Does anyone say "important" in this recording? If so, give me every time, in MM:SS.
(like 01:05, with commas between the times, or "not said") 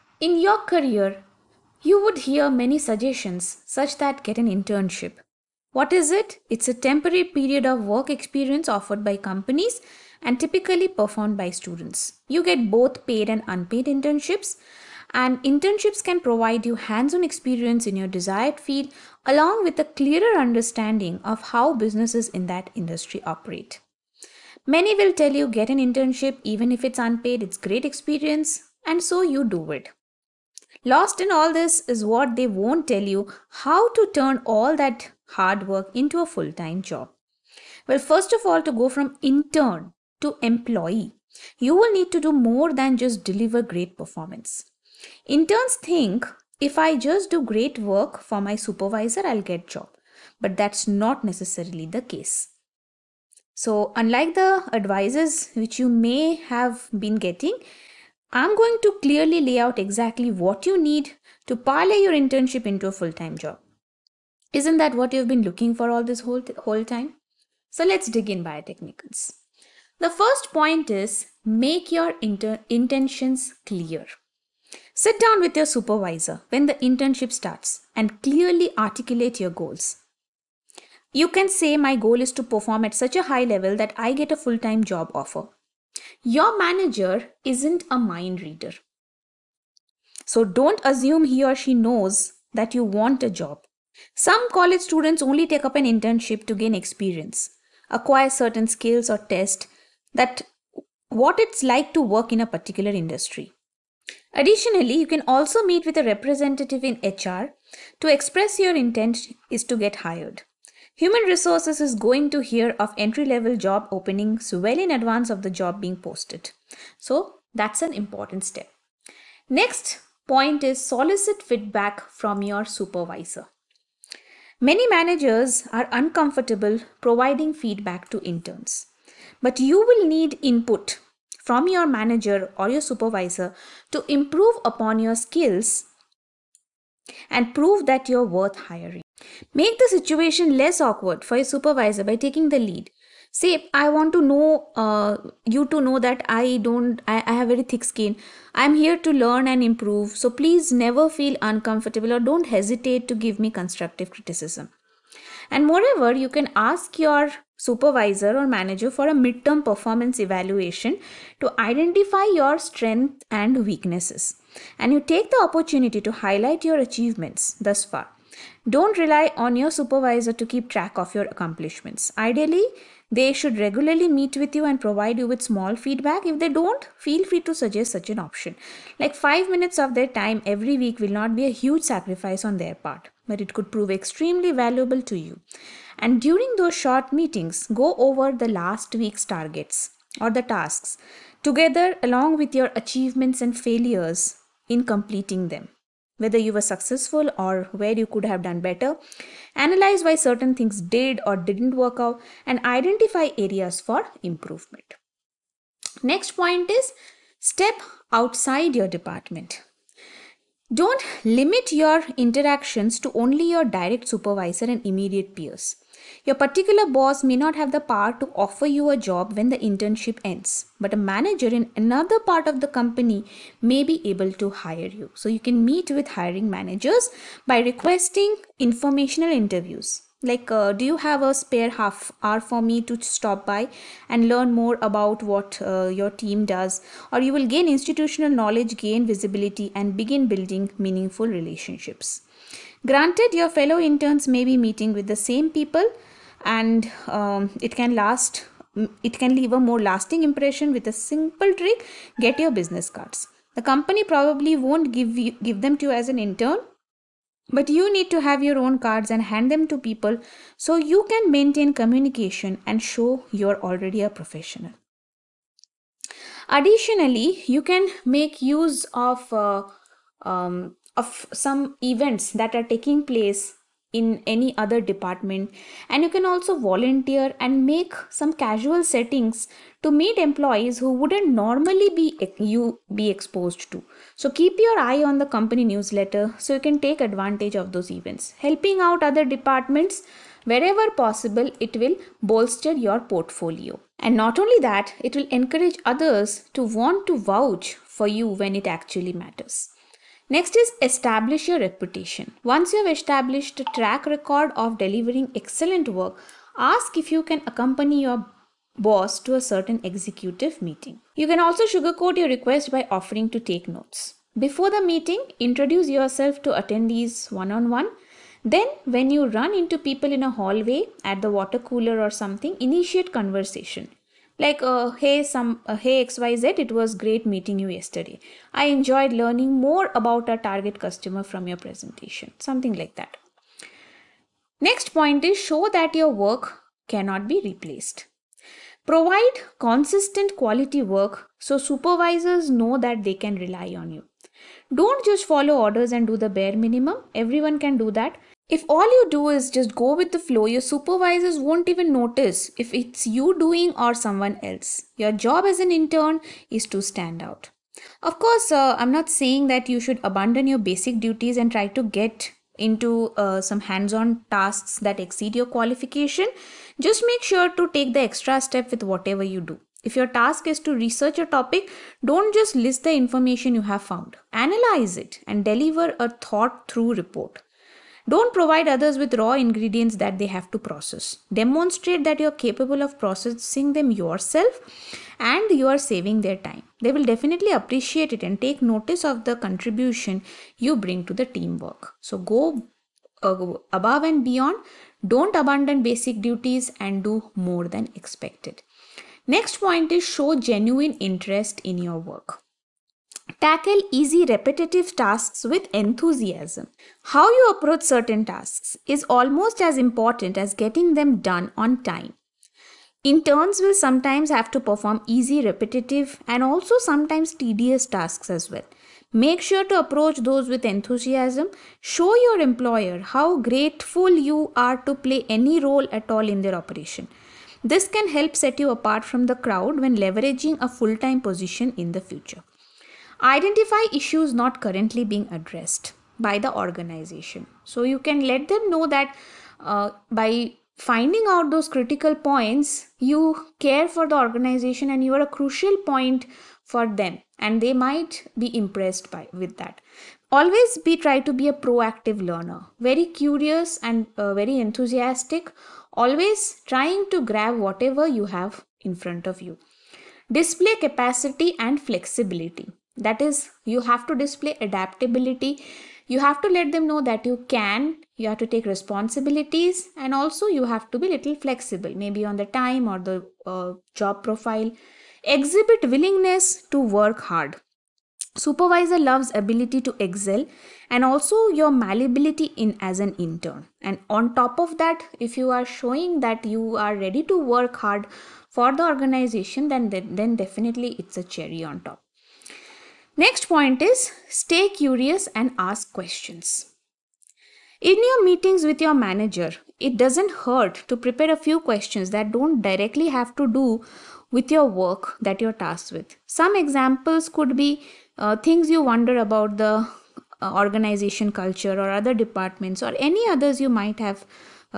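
01:57, 06:49.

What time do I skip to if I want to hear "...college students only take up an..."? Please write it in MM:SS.
01:34.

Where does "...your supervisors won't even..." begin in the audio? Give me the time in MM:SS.
05:50.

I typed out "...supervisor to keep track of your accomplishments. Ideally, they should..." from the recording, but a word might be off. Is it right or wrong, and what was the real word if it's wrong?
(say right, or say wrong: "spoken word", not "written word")
right.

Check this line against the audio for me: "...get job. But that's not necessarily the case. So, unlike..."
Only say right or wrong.
right.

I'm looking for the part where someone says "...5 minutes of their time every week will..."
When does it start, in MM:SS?
02:59.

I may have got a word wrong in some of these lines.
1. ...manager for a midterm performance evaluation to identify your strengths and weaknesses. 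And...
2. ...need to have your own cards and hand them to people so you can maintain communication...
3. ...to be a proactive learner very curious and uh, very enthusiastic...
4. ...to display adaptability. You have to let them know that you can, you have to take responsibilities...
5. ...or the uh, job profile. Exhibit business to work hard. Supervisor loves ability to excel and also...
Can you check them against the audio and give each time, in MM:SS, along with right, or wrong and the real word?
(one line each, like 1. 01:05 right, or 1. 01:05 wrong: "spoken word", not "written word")
1. 02:38 right
2. 04:17 right
3. 07:31 right
4. 07:44 right
5. 07:52 wrong: "willingness", not "business".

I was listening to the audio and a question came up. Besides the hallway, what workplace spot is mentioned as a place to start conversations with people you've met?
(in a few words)
water cooler.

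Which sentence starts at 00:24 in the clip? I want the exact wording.
Many will tell you get an internship even if it's unpaid, it's great experience, and so you do it.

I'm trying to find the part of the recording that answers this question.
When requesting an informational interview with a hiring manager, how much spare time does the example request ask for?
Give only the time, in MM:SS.
03:51.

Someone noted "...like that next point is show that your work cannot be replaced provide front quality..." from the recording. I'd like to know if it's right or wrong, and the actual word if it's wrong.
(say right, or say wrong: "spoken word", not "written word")
wrong: "consistent", not "front".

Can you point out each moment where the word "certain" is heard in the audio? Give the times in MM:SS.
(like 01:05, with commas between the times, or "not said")
01:38, 03:20, 05:09, 06:47.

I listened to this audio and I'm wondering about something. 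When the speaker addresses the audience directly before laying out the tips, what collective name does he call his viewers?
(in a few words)
Biotecnikans.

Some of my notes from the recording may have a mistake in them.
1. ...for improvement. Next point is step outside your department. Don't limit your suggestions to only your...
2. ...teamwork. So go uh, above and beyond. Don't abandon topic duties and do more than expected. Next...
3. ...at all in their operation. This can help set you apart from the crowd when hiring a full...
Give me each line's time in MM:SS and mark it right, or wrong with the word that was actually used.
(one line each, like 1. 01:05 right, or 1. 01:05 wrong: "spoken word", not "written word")
1. 03:23 wrong: "interactions", not "suggestions"
2. 06:31 wrong: "basic", not "topic"
3. 07:05 wrong: "leveraging", not "hiring".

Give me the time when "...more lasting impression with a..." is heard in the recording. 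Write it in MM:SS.
04:09.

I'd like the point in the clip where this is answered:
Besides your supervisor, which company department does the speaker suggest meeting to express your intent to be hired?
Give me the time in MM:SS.
01:47.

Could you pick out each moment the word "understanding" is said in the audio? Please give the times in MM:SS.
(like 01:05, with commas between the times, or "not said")
00:20.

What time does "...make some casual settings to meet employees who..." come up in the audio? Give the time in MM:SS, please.
04:37.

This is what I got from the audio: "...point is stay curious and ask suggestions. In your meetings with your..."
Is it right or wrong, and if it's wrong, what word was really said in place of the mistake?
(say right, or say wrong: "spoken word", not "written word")
wrong: "questions", not "suggestions".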